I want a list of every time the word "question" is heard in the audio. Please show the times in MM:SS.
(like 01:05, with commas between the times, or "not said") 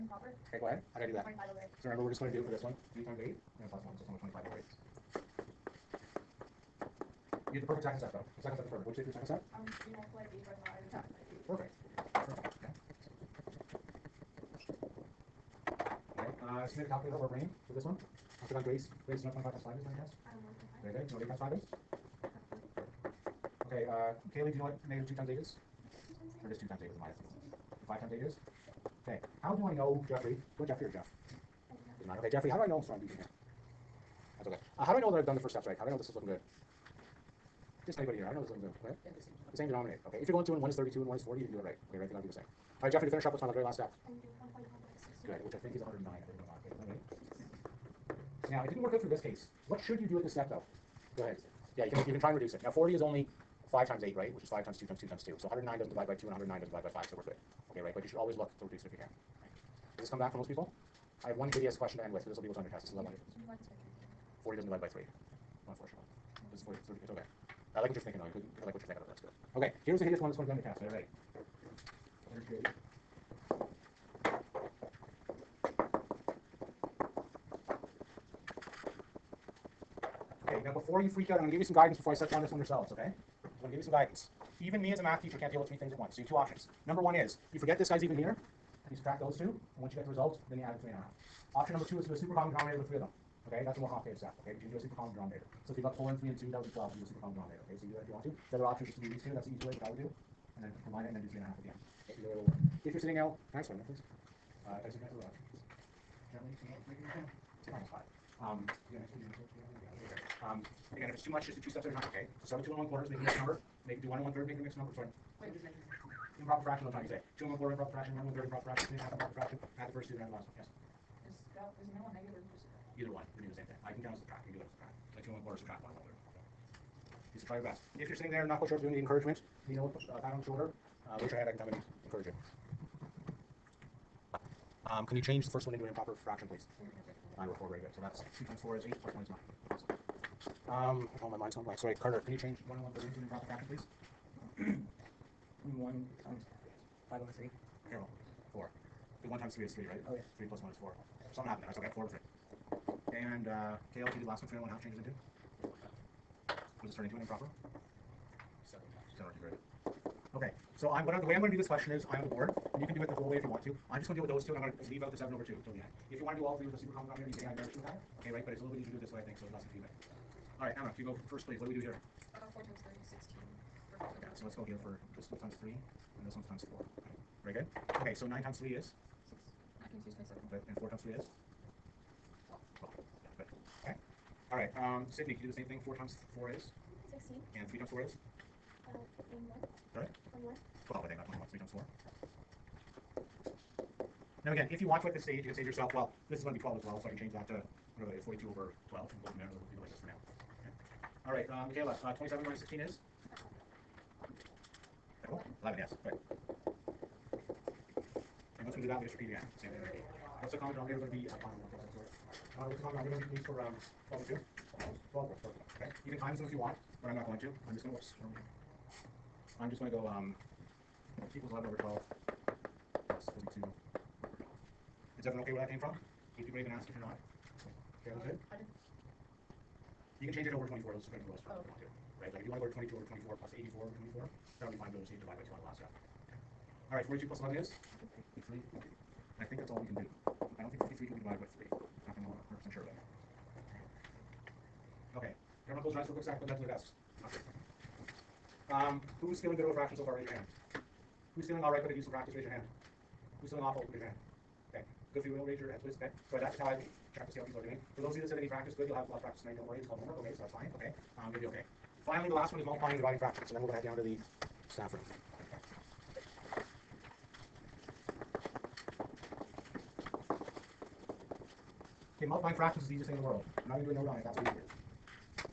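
01:01, 02:41.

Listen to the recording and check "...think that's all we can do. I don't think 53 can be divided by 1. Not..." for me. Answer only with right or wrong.
wrong.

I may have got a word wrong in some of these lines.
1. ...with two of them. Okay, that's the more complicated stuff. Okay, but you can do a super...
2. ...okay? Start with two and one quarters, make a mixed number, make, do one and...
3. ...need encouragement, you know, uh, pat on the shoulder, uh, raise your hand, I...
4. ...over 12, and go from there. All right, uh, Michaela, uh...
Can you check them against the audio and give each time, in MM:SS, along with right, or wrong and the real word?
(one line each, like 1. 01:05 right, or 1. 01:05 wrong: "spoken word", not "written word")
1. 01:32 wrong: "three", not "two"
2. 01:52 right
3. 02:08 right
4. 03:18 right.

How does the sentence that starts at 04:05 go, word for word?
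Everyone close their eyes for a quick second, put that to their desks.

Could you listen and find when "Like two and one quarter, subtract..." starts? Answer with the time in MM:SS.
02:05.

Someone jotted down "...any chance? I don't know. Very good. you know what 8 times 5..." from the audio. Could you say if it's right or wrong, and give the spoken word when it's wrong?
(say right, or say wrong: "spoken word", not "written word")
right.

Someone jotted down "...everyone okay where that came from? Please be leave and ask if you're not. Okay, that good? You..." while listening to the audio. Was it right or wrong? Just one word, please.
wrong.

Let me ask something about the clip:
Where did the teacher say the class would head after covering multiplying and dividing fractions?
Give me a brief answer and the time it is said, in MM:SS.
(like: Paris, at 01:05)
the saffron, at 04:24.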